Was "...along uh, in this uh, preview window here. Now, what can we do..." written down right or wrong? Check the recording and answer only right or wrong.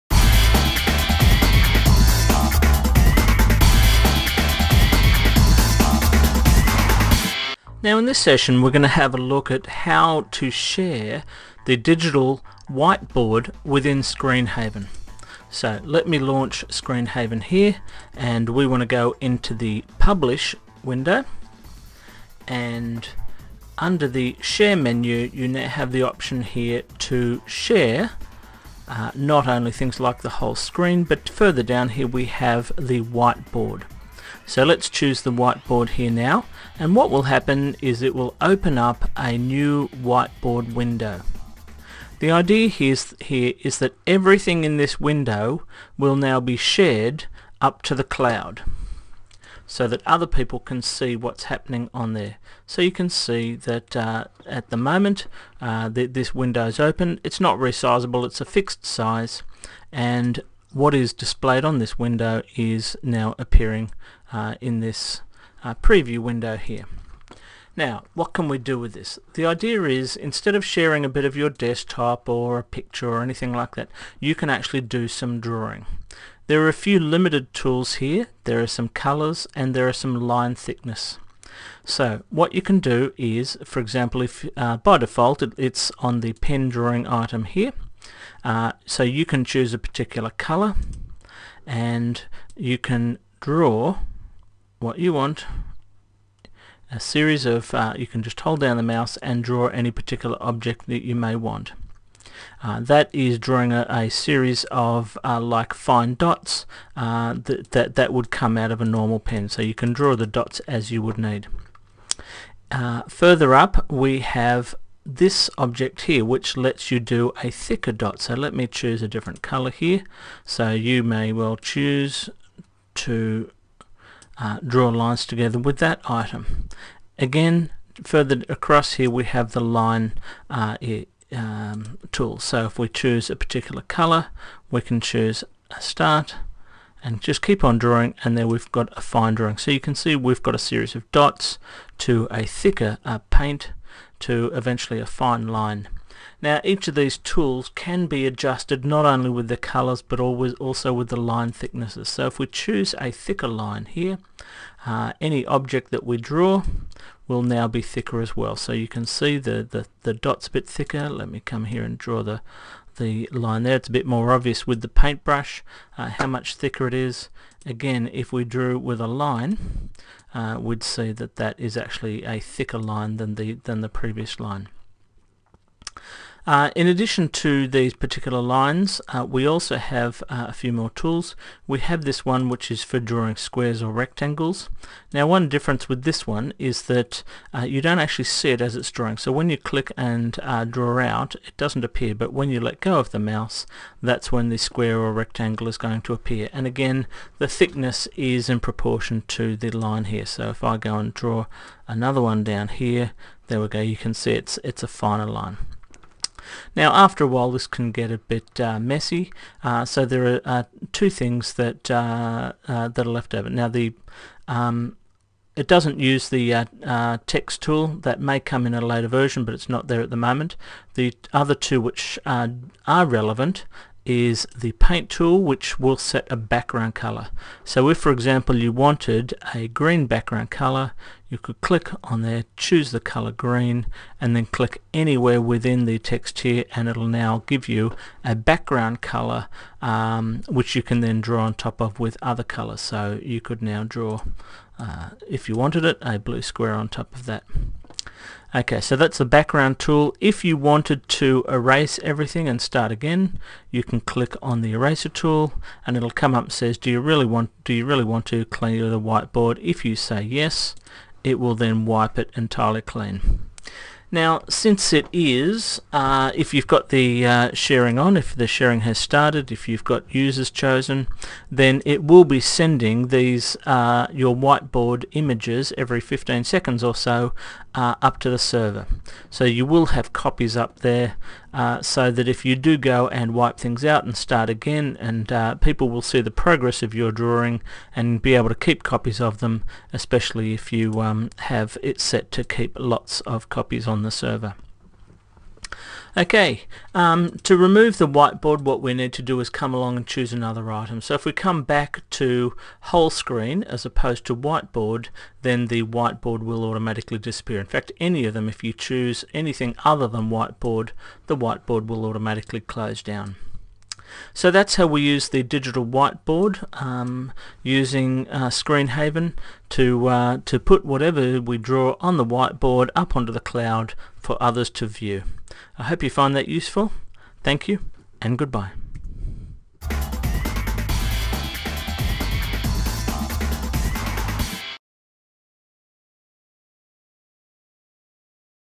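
wrong.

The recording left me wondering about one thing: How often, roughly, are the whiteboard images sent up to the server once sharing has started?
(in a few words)
Every 15 seconds.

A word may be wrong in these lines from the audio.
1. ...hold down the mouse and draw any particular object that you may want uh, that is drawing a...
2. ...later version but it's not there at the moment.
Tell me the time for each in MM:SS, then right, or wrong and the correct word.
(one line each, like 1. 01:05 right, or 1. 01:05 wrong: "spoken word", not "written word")
1. 01:38 right
2. 03:38 right.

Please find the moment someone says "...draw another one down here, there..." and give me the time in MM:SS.
03:21.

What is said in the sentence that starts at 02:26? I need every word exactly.
Now each of these tools can be adjusted not only with the colors but always also with the line thicknesses.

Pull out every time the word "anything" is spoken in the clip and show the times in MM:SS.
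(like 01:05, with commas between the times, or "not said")
01:13, 05:09.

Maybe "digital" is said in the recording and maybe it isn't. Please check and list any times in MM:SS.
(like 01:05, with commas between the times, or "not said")
00:11, 05:15.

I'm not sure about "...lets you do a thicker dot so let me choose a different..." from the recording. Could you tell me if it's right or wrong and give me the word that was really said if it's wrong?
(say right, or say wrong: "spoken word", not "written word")
right.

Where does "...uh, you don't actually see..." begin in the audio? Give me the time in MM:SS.
03:07.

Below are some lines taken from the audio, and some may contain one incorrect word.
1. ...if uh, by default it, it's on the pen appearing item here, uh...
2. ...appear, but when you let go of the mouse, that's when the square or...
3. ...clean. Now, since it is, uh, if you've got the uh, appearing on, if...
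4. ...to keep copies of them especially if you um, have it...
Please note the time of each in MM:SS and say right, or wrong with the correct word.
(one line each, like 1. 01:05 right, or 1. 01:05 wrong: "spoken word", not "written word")
1. 01:24 wrong: "drawing", not "appearing"
2. 03:11 right
3. 04:22 wrong: "sharing", not "appearing"
4. 04:48 right.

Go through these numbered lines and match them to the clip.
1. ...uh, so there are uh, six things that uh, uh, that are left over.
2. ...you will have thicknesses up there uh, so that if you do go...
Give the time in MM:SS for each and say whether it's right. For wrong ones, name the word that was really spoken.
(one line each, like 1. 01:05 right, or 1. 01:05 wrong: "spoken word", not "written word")
1. 03:29 wrong: "two", not "six"
2. 04:39 wrong: "copies", not "thicknesses".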